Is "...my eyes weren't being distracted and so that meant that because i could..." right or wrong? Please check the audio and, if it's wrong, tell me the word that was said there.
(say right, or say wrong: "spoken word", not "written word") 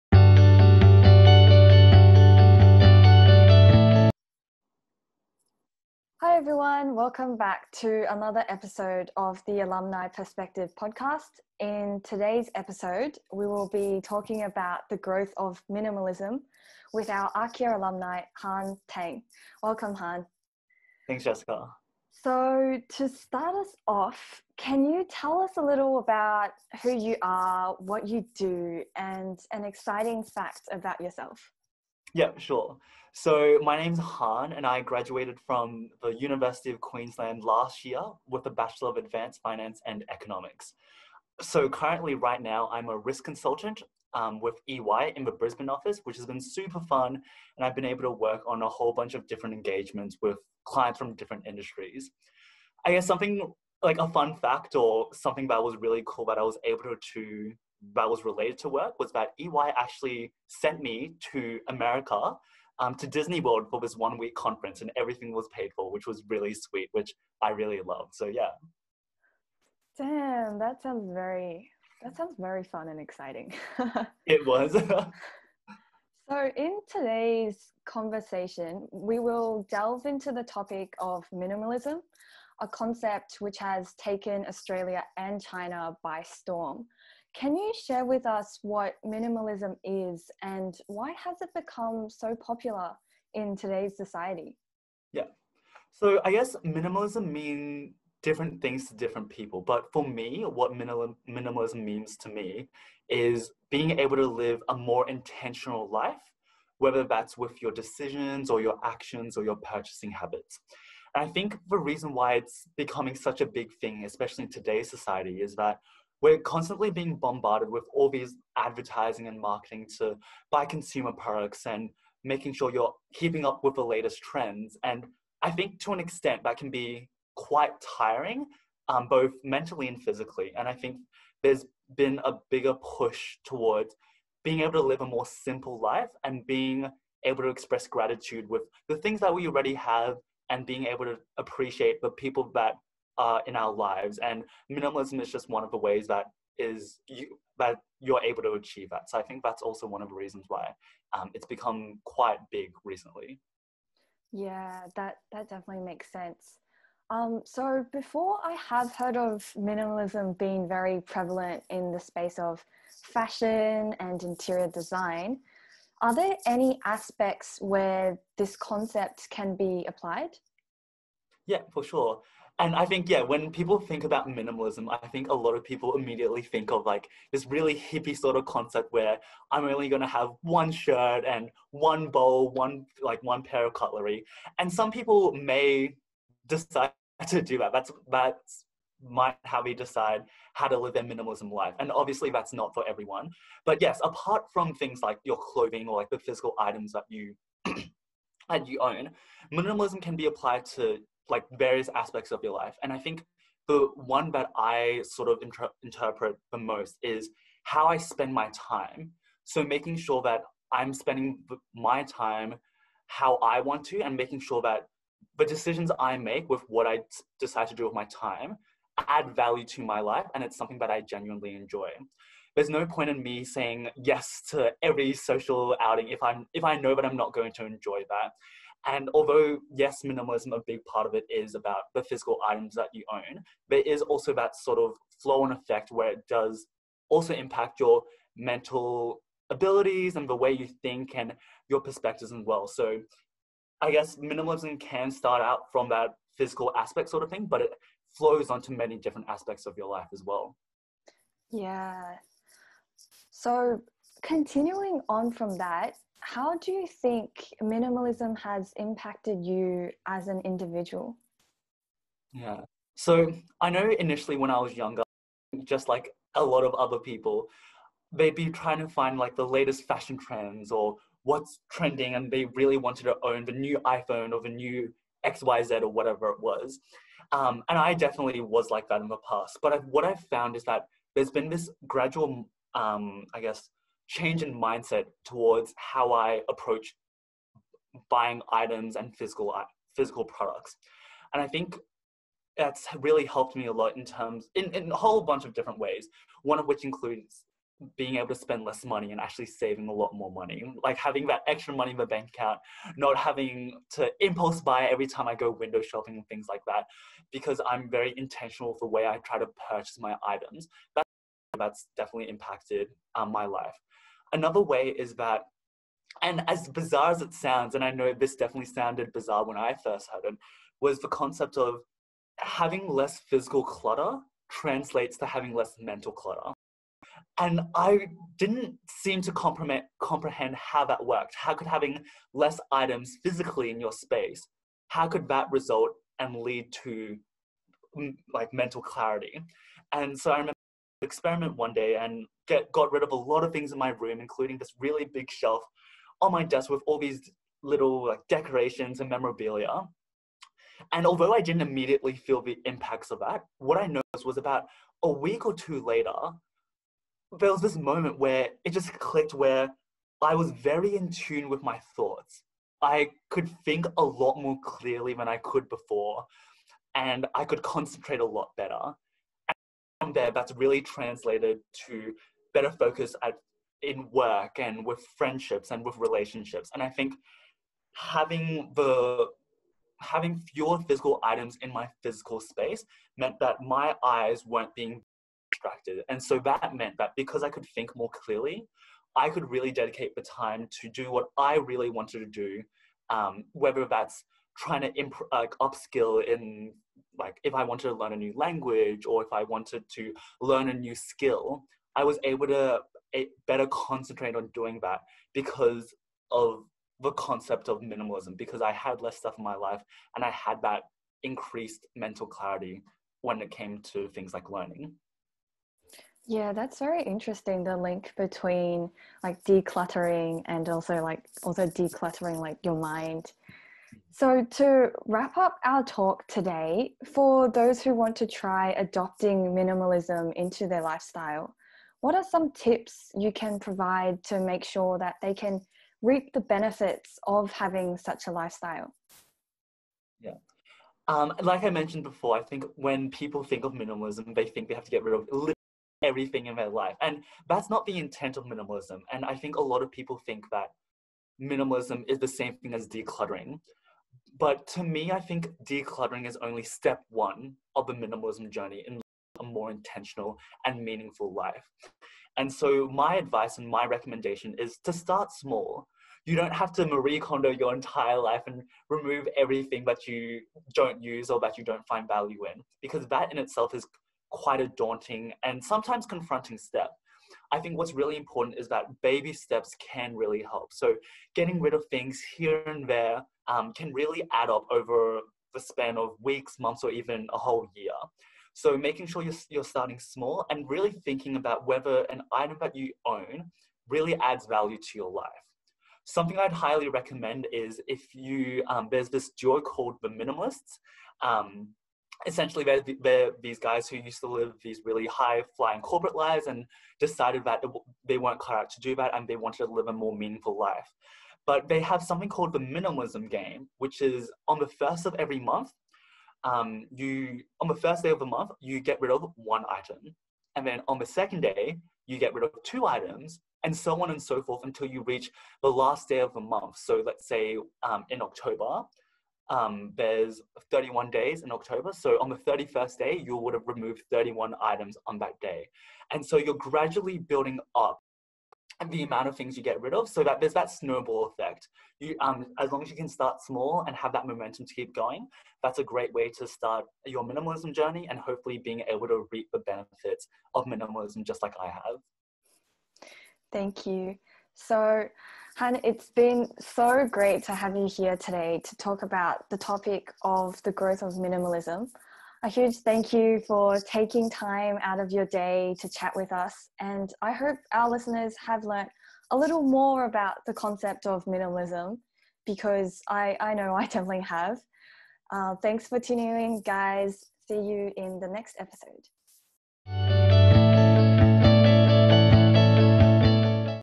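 right.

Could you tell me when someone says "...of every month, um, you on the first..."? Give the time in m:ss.
8:35.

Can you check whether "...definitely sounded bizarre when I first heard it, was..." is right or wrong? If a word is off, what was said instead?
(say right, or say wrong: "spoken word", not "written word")
right.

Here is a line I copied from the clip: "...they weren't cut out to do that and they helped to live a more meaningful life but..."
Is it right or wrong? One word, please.
wrong.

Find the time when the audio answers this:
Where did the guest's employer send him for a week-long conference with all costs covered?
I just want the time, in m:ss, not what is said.
1:03.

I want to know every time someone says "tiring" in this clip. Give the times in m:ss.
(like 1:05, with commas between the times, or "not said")
2:07.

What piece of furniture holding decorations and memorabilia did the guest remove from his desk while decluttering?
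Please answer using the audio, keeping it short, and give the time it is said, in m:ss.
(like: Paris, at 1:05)
Shelf, at 5:45.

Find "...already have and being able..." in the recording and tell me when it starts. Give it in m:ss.
2:19.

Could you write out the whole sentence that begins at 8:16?
Something I'd highly recommend is if you, um, there's this duo called the Minimalists.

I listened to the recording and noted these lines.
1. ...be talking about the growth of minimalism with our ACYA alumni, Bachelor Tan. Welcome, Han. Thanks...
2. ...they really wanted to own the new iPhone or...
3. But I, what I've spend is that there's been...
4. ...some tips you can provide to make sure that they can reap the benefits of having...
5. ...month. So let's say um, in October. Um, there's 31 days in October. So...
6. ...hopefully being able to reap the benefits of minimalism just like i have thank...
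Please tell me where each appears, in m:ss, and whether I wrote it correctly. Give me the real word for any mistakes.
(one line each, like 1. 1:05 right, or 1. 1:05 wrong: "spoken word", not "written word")
1. 0:13 wrong: "Han", not "Bachelor"
2. 4:32 right
3. 4:39 wrong: "found", not "spend"
4. 7:12 right
5. 8:46 right
6. 9:08 right.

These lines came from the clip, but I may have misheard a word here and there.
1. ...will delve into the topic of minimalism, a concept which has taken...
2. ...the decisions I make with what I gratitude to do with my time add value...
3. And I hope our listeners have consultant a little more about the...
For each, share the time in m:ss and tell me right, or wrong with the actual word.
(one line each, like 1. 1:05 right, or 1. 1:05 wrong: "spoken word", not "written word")
1. 1:19 right
2. 3:35 wrong: "decide", not "gratitude"
3. 9:26 wrong: "learnt", not "consultant".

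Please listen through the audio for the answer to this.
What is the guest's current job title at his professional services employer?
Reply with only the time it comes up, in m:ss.
0:42.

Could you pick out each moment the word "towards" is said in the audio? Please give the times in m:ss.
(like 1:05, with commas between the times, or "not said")
2:13, 4:45.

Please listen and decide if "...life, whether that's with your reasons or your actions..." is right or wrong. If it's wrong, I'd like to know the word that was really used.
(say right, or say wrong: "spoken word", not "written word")
wrong: "decisions", not "reasons".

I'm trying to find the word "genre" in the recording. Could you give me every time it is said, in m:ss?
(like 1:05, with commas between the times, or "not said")
not said.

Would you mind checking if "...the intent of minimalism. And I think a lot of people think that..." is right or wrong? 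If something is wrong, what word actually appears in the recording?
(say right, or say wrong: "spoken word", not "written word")
right.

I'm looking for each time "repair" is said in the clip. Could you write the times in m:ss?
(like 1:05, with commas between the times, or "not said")
not said.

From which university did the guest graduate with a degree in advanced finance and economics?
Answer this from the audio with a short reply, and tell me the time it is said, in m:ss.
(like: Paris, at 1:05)
University of Queensland, at 0:36.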